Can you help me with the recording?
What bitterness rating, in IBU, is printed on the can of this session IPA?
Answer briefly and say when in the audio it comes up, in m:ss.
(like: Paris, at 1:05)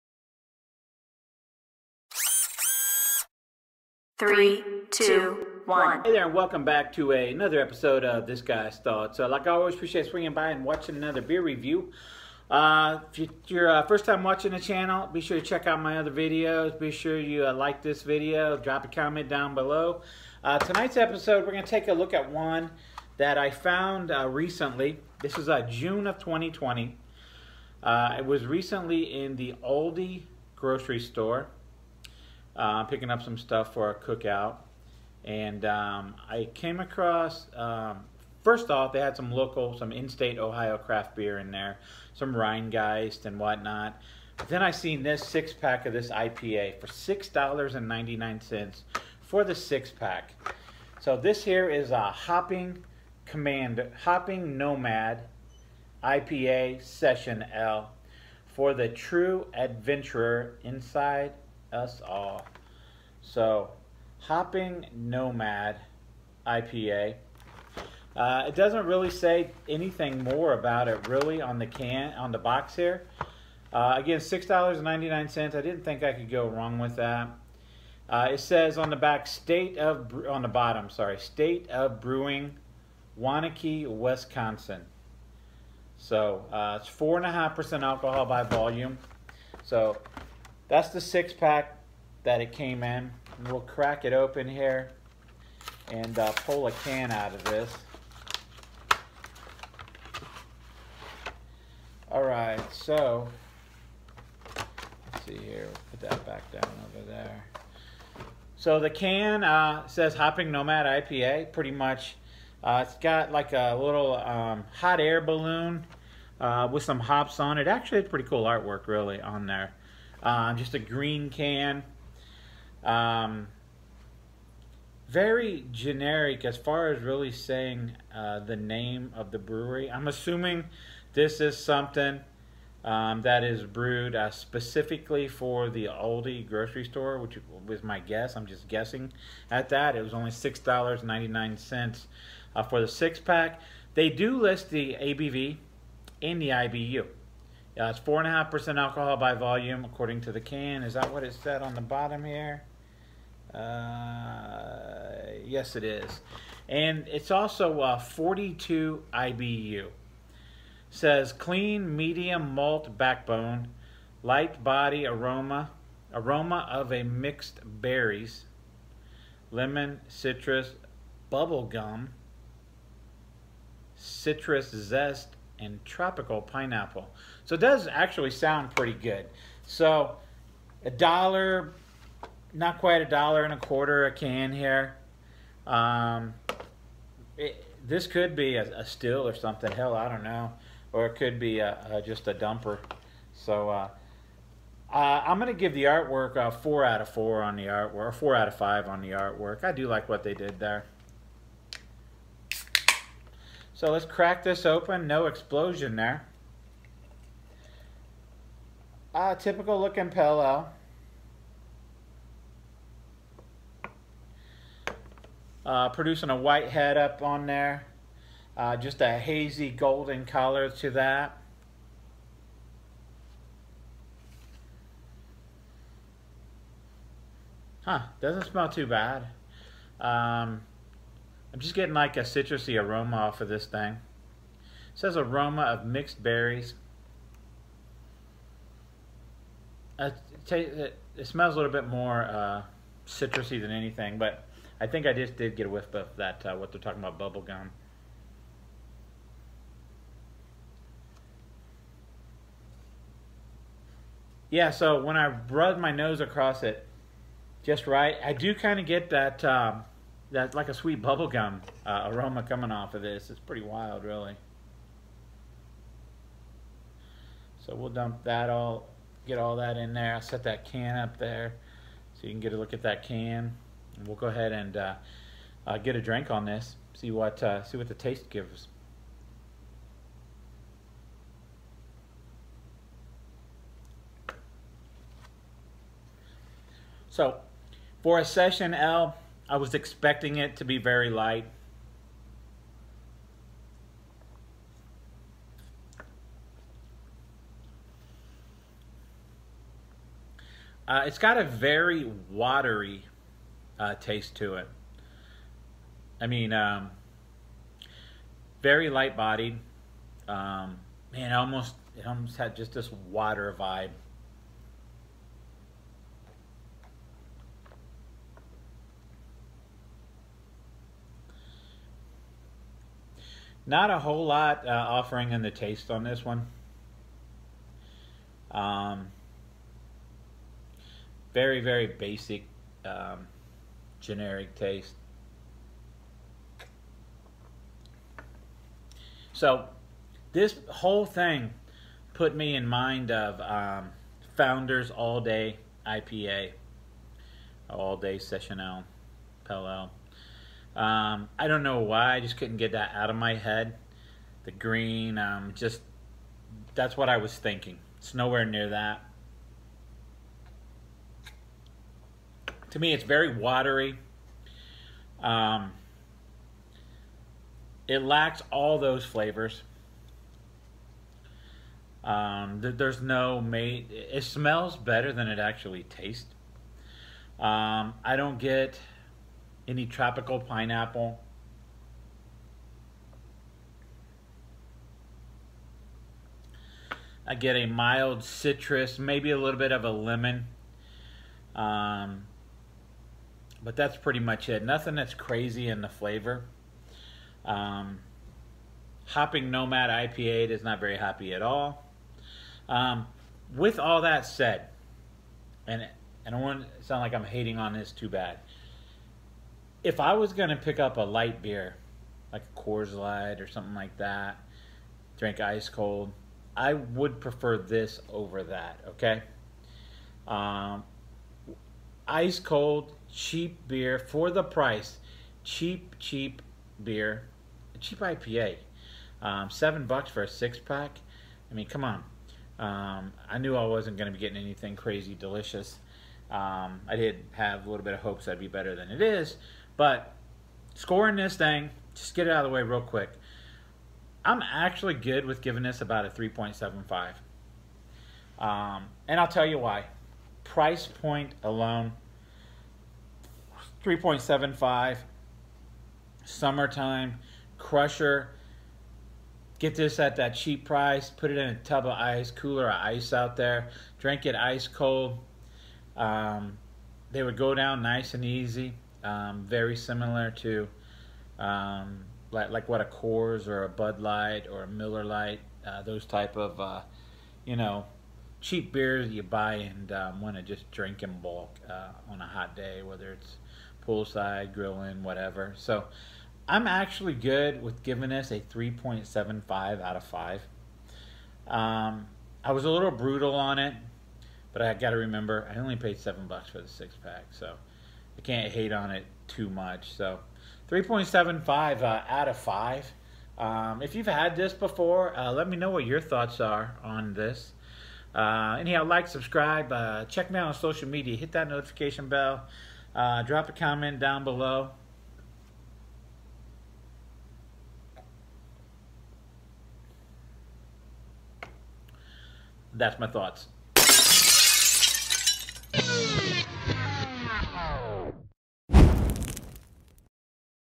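42, at 2:37.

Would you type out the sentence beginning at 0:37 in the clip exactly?
Um, first off, they had some local, some in-state Ohio craft beer in there, some Rhinegeist and whatnot.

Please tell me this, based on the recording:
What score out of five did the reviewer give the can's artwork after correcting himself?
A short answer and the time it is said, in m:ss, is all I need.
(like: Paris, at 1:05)
4, at 3:18.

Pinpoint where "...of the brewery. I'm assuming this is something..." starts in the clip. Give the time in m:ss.
2:09.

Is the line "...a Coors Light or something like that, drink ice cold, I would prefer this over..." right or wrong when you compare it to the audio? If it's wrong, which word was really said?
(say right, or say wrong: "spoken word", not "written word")
right.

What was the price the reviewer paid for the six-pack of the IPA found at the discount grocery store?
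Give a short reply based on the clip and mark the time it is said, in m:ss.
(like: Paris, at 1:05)
$6.99, at 0:46.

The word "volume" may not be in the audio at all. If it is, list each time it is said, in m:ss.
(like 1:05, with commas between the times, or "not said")
1:28, 2:29.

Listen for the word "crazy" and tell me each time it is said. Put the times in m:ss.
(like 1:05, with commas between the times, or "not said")
6:35, 7:14.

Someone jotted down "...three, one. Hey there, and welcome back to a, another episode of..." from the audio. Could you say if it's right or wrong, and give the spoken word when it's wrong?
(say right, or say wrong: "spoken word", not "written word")
wrong: "two", not "three".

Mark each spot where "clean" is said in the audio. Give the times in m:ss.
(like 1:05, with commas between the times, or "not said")
2:41.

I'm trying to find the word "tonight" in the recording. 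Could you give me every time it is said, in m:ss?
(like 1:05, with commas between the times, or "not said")
0:20.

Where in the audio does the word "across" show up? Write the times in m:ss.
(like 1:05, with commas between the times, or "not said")
0:36, 4:16.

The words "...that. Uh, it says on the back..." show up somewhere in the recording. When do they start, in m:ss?
1:16.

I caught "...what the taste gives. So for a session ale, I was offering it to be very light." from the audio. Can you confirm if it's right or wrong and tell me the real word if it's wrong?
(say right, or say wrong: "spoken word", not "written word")
wrong: "expecting", not "offering".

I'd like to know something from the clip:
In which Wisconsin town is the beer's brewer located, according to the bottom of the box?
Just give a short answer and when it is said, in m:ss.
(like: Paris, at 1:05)
Waunakee, at 1:23.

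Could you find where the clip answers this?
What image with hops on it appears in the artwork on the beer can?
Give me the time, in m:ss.
1:54.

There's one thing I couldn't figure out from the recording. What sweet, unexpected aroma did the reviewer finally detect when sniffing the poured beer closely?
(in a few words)
bubblegum.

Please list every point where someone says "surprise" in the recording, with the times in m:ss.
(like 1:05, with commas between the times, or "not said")
not said.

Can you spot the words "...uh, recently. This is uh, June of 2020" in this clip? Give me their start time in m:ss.
0:24.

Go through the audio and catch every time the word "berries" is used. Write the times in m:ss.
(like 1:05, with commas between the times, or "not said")
2:47, 3:56.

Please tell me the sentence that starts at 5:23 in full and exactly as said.
Not a whole lot uh, offering in the taste on this one.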